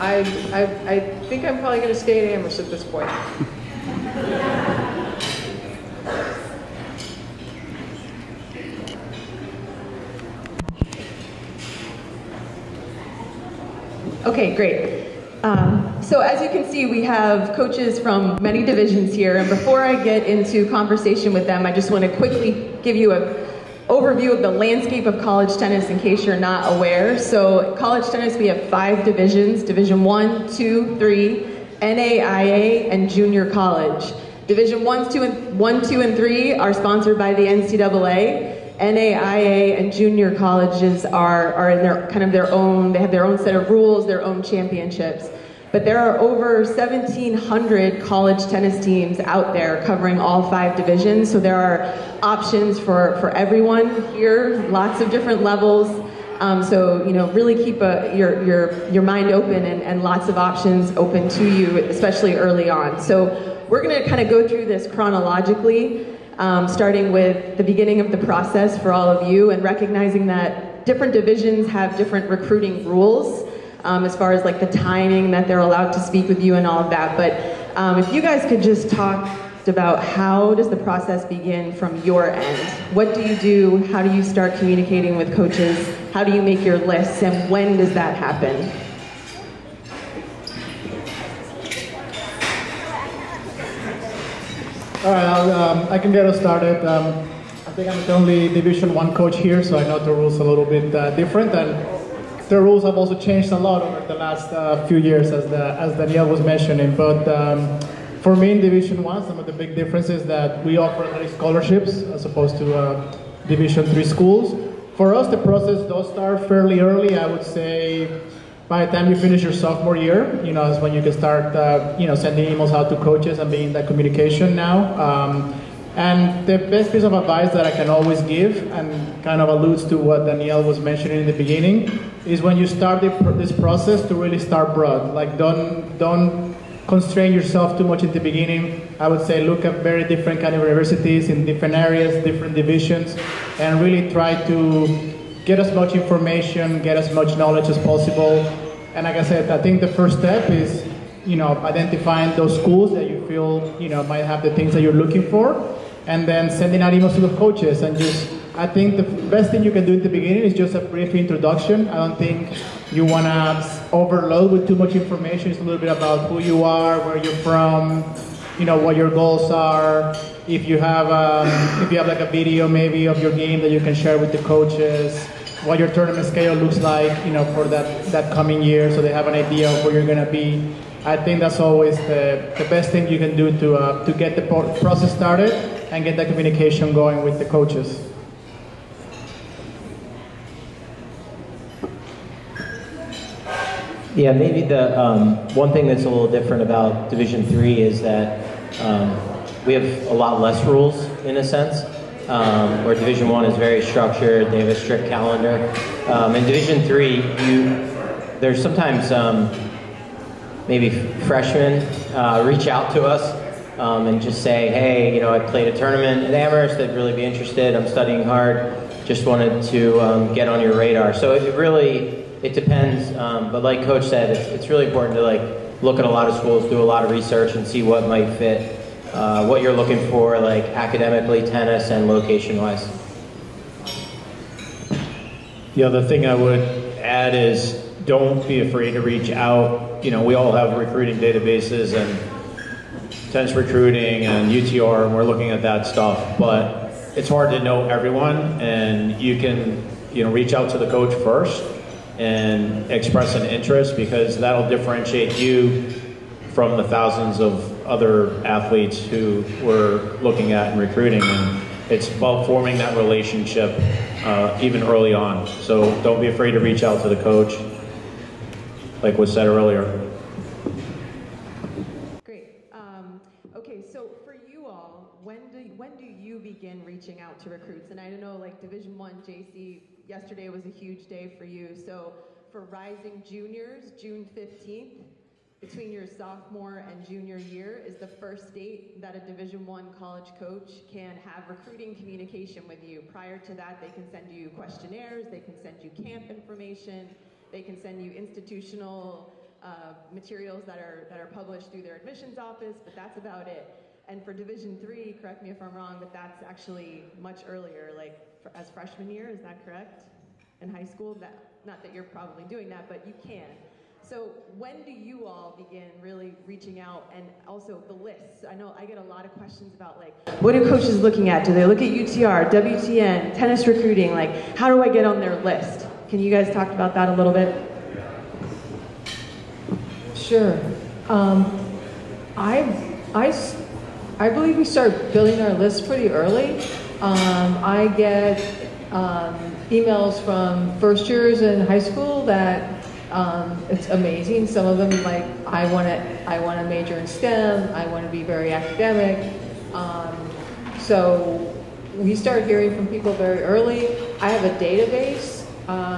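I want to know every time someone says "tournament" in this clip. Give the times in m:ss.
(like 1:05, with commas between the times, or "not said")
2:55, 3:35.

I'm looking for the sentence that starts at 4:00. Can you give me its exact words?
You know, we all have recruiting databases and tennis recruiting and UTR, and we're looking at that stuff.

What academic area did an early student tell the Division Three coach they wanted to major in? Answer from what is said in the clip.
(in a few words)
STEM.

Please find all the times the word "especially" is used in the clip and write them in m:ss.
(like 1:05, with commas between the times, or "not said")
1:01.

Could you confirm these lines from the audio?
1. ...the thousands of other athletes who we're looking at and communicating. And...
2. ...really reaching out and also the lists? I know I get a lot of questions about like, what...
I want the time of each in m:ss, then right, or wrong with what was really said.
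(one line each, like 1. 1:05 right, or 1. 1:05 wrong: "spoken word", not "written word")
1. 4:16 wrong: "recruiting", not "communicating"
2. 5:15 right.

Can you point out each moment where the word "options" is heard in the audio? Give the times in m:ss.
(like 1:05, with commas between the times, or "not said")
0:52, 1:00.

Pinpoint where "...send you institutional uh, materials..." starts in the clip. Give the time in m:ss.
4:57.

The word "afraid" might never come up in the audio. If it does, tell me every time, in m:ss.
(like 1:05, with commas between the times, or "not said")
3:58, 4:26.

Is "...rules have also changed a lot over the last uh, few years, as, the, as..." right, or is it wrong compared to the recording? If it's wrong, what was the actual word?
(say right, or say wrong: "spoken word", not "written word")
right.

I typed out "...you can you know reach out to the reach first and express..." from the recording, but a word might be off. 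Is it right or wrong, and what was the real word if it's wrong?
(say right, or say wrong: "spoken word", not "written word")
wrong: "coach", not "reach".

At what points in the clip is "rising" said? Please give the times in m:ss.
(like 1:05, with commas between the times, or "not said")
4:42.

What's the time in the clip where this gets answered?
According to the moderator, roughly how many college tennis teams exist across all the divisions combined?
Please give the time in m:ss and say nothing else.
0:46.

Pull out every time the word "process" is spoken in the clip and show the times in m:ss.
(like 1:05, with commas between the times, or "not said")
1:08, 1:20, 1:55, 2:13, 3:04.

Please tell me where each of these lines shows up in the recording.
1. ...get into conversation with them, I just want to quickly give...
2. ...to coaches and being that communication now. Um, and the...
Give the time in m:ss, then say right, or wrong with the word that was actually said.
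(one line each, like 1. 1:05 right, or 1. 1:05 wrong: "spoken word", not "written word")
1. 0:20 right
2. 2:02 right.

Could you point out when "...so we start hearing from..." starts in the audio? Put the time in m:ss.
5:50.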